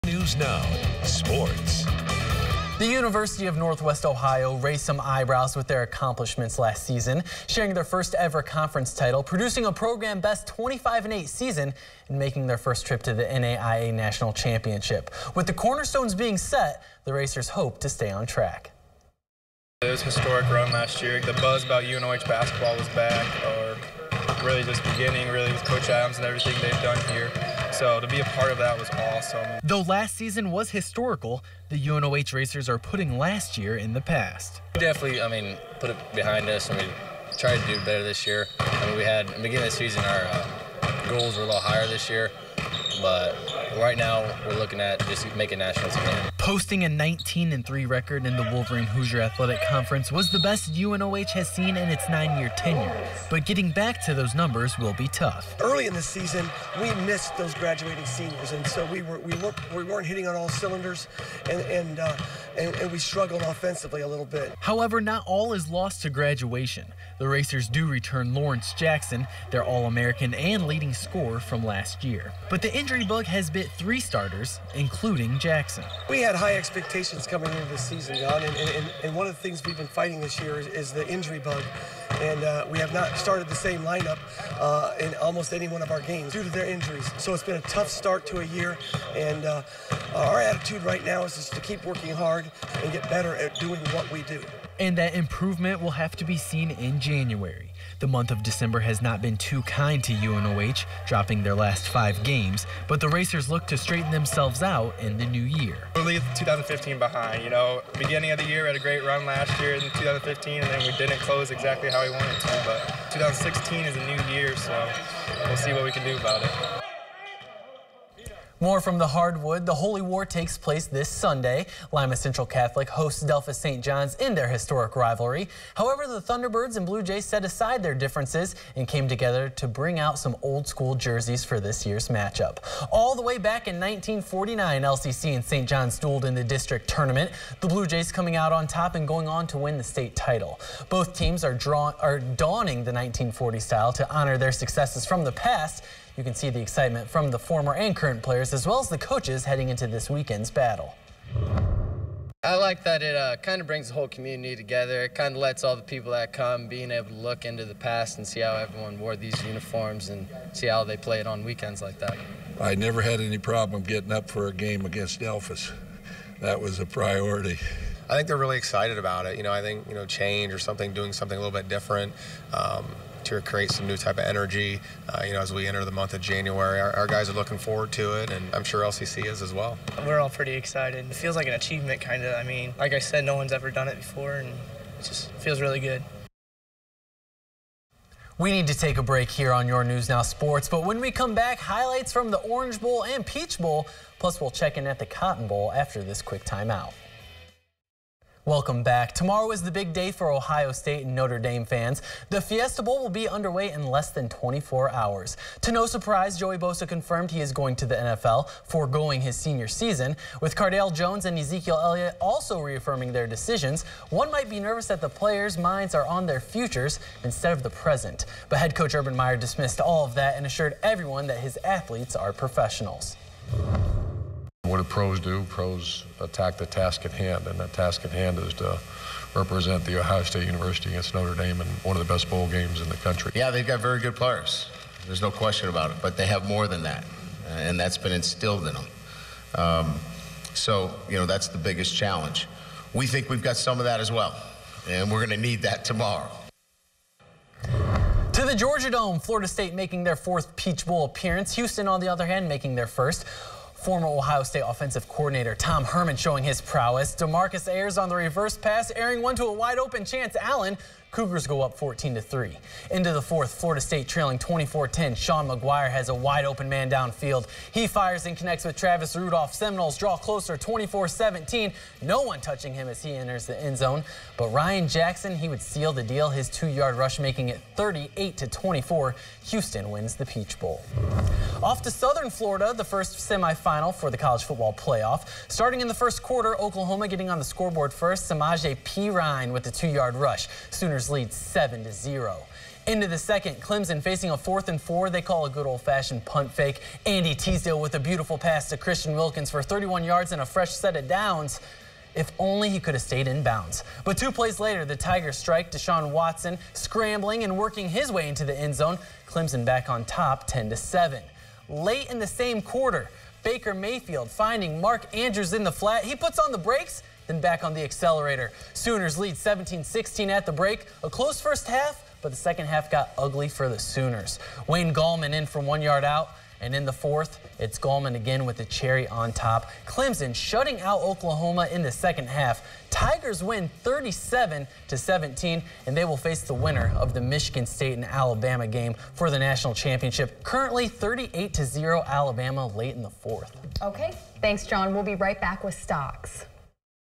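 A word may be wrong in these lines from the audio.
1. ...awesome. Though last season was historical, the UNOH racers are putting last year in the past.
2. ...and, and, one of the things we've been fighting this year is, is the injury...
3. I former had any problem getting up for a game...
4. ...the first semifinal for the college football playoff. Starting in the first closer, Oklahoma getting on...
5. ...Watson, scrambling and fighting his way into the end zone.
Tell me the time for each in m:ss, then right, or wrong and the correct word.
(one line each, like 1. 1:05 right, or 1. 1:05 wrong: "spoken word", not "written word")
1. 0:28 right
2. 1:18 right
3. 2:42 wrong: "never", not "former"
4. 4:42 wrong: "quarter", not "closer"
5. 5:06 wrong: "working", not "fighting".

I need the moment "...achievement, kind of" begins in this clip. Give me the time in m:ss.
3:01.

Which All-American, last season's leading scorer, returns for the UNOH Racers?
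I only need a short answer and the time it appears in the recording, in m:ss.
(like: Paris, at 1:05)
Lawrence Jackson, at 1:08.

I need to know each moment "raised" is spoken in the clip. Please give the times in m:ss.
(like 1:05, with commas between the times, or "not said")
0:04.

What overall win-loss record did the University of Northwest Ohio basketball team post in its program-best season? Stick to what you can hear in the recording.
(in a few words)
25-8.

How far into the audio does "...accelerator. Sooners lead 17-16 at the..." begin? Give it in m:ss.
5:17.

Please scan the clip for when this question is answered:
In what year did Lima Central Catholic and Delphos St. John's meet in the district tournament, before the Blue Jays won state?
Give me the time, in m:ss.
2:13.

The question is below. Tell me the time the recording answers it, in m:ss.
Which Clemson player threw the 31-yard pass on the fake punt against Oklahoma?
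4:57.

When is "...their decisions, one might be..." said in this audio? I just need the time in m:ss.
3:33.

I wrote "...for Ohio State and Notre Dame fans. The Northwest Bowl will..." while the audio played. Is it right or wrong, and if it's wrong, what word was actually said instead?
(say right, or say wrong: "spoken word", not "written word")
wrong: "Fiesta", not "Northwest".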